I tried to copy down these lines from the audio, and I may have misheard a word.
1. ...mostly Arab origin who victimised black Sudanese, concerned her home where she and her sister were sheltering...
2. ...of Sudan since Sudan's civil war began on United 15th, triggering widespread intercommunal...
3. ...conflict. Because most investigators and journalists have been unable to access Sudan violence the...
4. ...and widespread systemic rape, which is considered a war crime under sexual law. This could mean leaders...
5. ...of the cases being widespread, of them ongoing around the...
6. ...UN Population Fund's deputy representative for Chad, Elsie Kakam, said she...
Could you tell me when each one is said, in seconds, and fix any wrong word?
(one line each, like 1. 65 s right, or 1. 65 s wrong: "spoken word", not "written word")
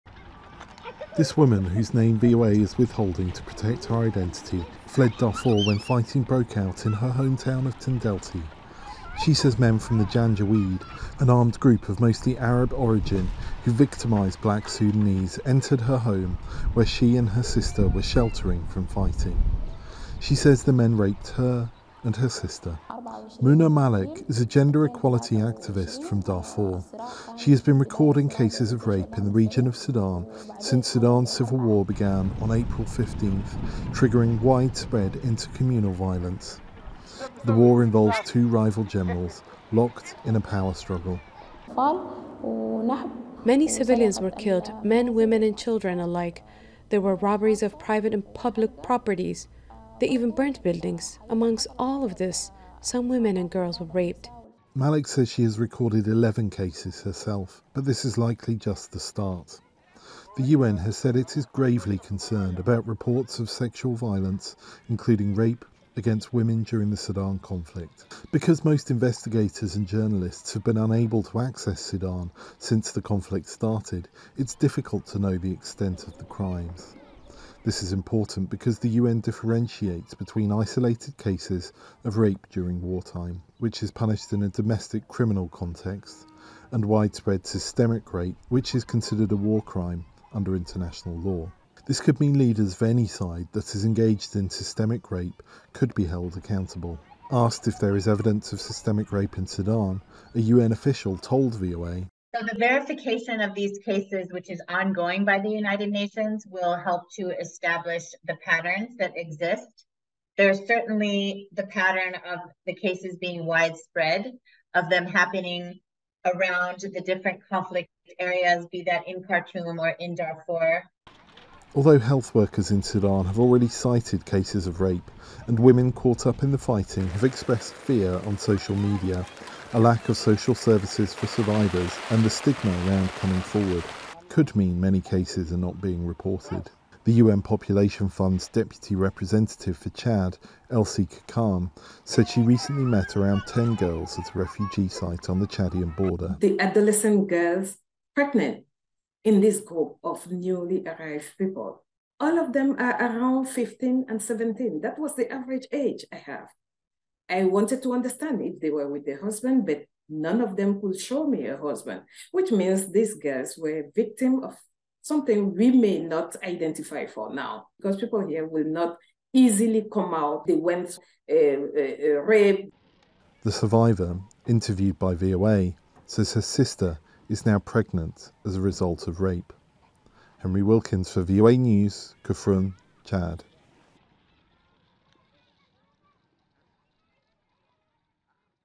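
1. 11 s wrong: "entered", not "concerned"
2. 29 s wrong: "April", not "United"
3. 67 s wrong: "since", not "violence"
4. 86 s wrong: "international", not "sexual"
5. 112 s wrong: "happening", not "ongoing"
6. 137 s right.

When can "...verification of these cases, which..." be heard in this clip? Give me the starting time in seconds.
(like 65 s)
102 s.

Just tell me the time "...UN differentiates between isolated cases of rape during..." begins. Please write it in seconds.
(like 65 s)
78 s.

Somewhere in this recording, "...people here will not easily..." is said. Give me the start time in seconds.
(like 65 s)
167 s.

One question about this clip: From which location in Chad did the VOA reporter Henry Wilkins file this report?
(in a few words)
Koufroun.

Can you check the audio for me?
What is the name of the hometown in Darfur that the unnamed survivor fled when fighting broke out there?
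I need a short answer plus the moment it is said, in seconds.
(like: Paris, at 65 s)
Tendelti, at 7 s.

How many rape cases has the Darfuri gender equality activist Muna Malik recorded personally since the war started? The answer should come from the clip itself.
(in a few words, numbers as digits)
11.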